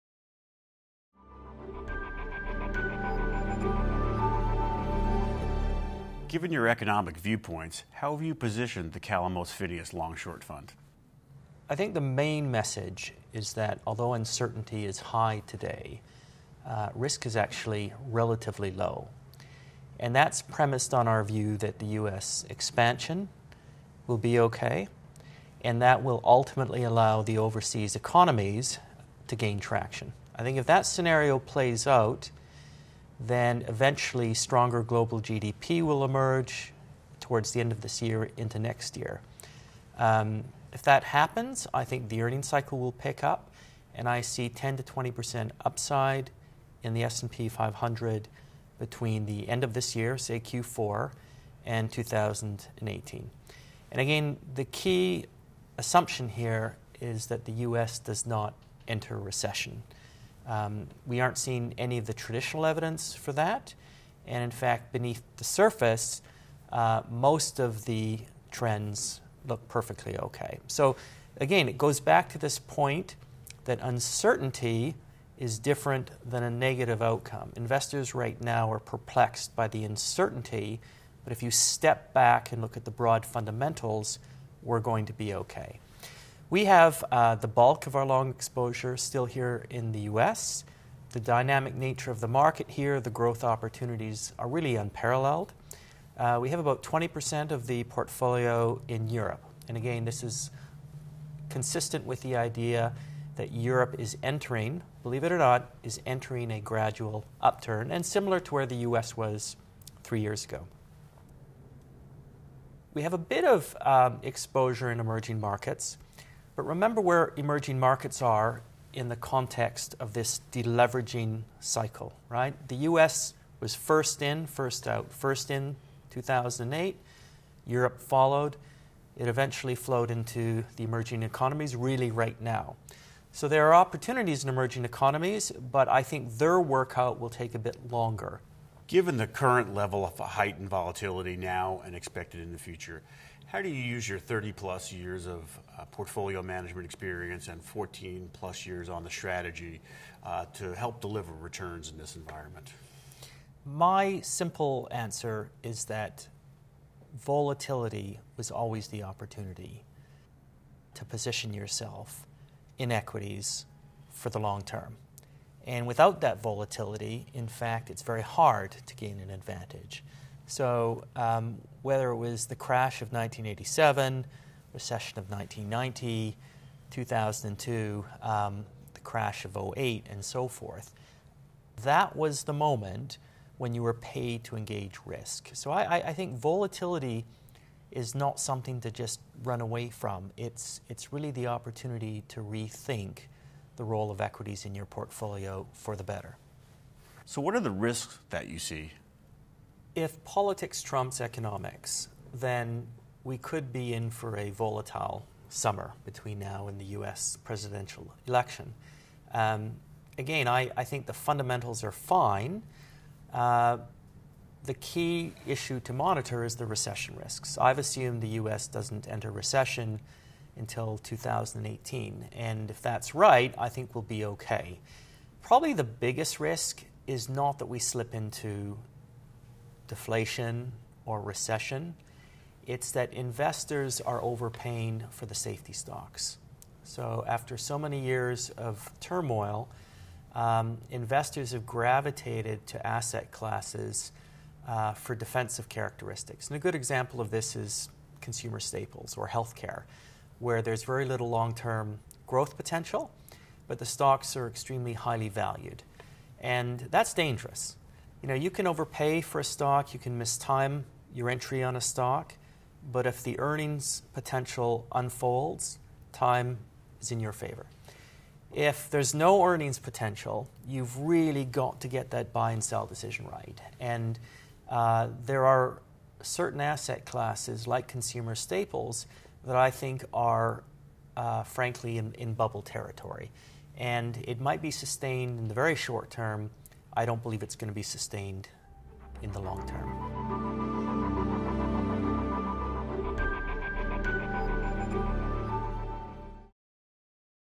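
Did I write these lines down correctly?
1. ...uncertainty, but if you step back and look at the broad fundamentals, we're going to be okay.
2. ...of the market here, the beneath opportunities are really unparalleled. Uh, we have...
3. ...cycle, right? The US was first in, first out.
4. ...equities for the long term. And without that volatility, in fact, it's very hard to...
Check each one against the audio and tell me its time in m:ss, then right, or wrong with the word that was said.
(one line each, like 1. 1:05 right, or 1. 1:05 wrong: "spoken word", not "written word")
1. 1:19 right
2. 1:32 wrong: "growth", not "beneath"
3. 2:01 right
4. 2:42 right.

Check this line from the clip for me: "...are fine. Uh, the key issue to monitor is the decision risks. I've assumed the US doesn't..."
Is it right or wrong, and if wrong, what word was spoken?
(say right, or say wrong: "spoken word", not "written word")
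wrong: "recession", not "decision".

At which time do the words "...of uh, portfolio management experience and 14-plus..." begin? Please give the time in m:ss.
2:25.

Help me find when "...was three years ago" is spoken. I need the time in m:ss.
1:49.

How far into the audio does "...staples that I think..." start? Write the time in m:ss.
4:38.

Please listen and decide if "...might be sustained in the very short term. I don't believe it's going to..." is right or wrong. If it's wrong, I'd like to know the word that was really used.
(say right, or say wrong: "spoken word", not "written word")
right.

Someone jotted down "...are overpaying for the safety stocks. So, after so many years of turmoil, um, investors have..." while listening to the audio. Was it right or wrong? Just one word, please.
right.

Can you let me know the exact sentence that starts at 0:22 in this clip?
expansion will be okay, and that will ultimately allow the overseas economies to gain traction.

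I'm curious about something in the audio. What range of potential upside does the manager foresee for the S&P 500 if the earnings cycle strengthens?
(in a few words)
10 to 20 percent.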